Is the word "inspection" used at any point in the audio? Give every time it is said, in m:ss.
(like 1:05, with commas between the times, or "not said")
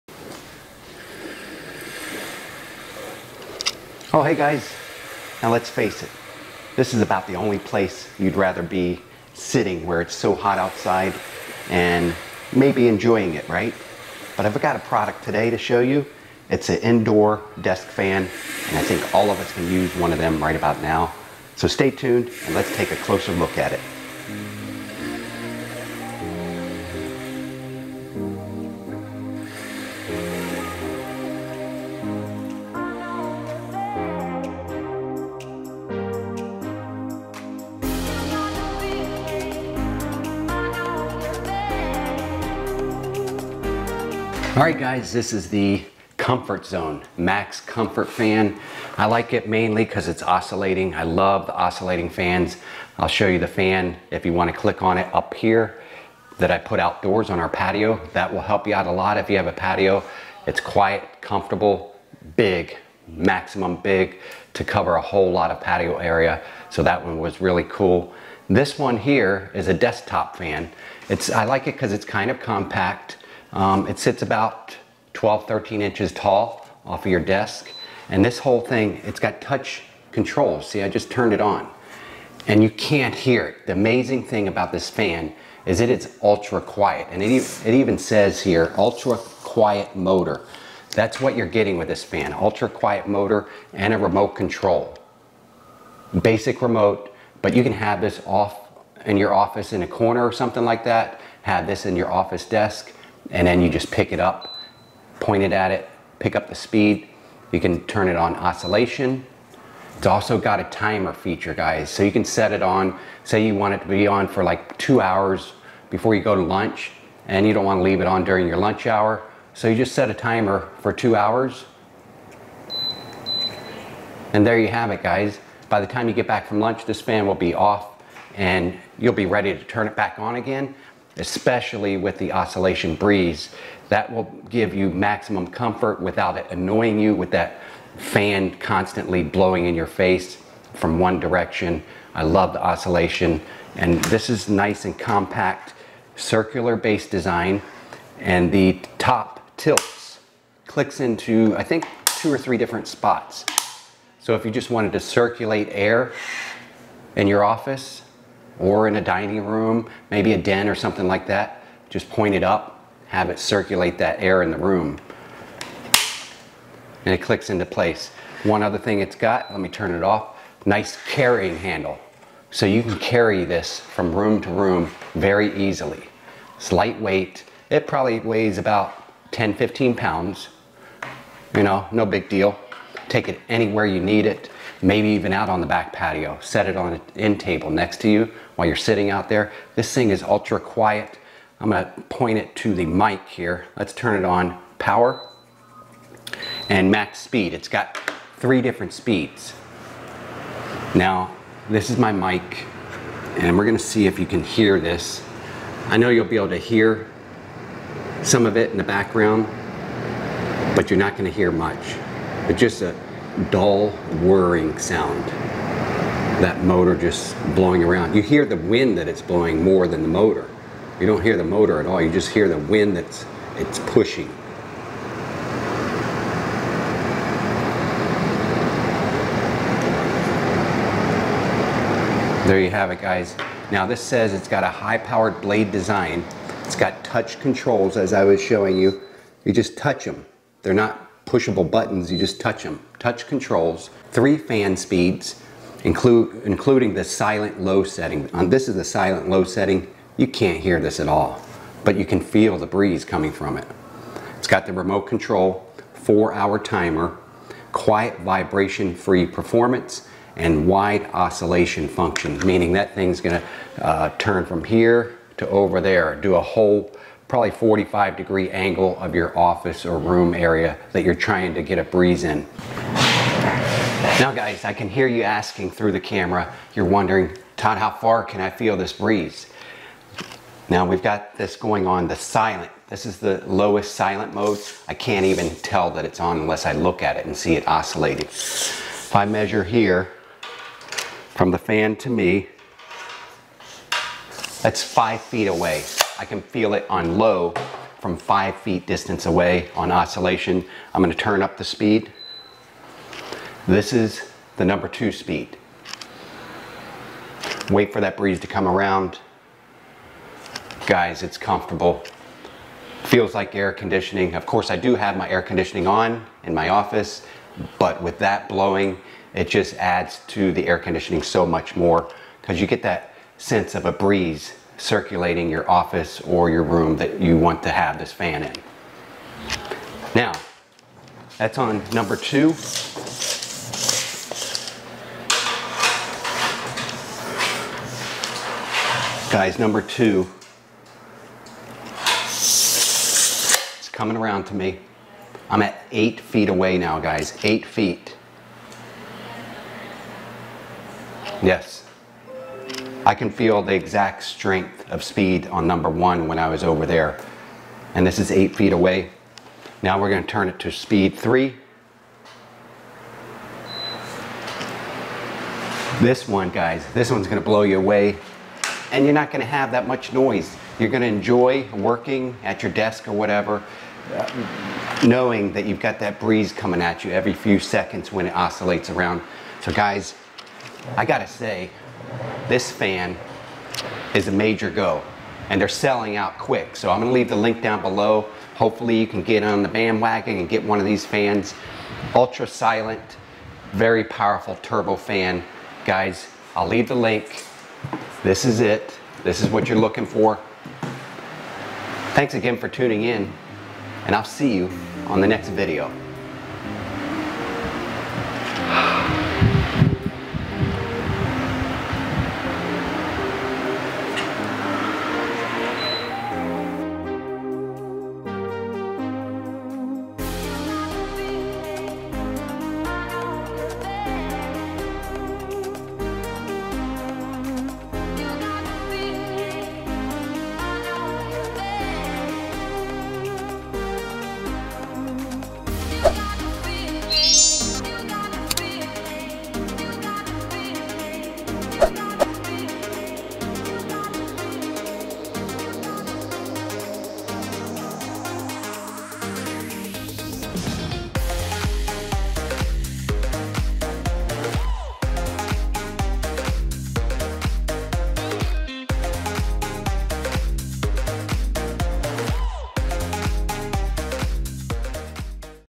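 not said.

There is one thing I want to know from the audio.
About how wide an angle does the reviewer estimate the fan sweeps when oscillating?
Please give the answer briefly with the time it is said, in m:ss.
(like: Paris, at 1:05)
45 degrees, at 4:27.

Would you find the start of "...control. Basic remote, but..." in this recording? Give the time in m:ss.
1:34.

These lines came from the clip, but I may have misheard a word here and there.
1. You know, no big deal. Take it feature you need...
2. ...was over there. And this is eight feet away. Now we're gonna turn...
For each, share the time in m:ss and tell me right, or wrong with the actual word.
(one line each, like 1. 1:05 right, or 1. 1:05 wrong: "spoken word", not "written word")
1. 3:01 wrong: "anywhere", not "feature"
2. 5:56 right.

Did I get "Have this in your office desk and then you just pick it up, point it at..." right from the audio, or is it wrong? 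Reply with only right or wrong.
right.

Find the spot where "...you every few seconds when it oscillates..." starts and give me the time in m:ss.
6:17.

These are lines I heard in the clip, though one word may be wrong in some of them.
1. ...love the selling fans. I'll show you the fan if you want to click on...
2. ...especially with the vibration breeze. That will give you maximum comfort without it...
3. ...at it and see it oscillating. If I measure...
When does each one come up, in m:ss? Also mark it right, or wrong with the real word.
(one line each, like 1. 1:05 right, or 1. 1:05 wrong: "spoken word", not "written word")
1. 0:51 wrong: "oscillating", not "selling"
2. 2:11 wrong: "oscillation", not "vibration"
3. 4:47 right.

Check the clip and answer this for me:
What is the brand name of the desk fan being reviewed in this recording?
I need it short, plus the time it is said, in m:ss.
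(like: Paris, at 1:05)
Comfort Zone, at 0:46.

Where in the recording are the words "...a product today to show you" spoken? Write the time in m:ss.
0:14.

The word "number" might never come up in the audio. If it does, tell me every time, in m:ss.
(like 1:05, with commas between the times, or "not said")
5:04, 5:31, 5:39, 5:55.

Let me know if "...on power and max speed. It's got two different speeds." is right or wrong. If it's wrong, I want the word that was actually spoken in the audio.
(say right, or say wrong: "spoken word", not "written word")
wrong: "three", not "two".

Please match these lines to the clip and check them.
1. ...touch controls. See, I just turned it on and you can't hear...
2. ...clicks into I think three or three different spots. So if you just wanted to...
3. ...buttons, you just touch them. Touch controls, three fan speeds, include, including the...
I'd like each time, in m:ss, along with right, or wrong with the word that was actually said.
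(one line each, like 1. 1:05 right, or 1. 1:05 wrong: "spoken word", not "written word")
1. 1:19 right
2. 2:30 wrong: "two", not "three"
3. 4:01 right.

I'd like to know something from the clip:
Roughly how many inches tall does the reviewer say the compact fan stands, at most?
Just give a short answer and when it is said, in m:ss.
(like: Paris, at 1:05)
13, at 1:15.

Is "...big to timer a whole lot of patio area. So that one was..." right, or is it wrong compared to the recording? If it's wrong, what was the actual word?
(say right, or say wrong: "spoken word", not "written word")
wrong: "cover", not "timer".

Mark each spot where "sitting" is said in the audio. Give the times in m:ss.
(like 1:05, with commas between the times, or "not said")
0:09, 3:08.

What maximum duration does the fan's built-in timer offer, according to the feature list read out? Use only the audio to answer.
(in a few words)
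4 hours.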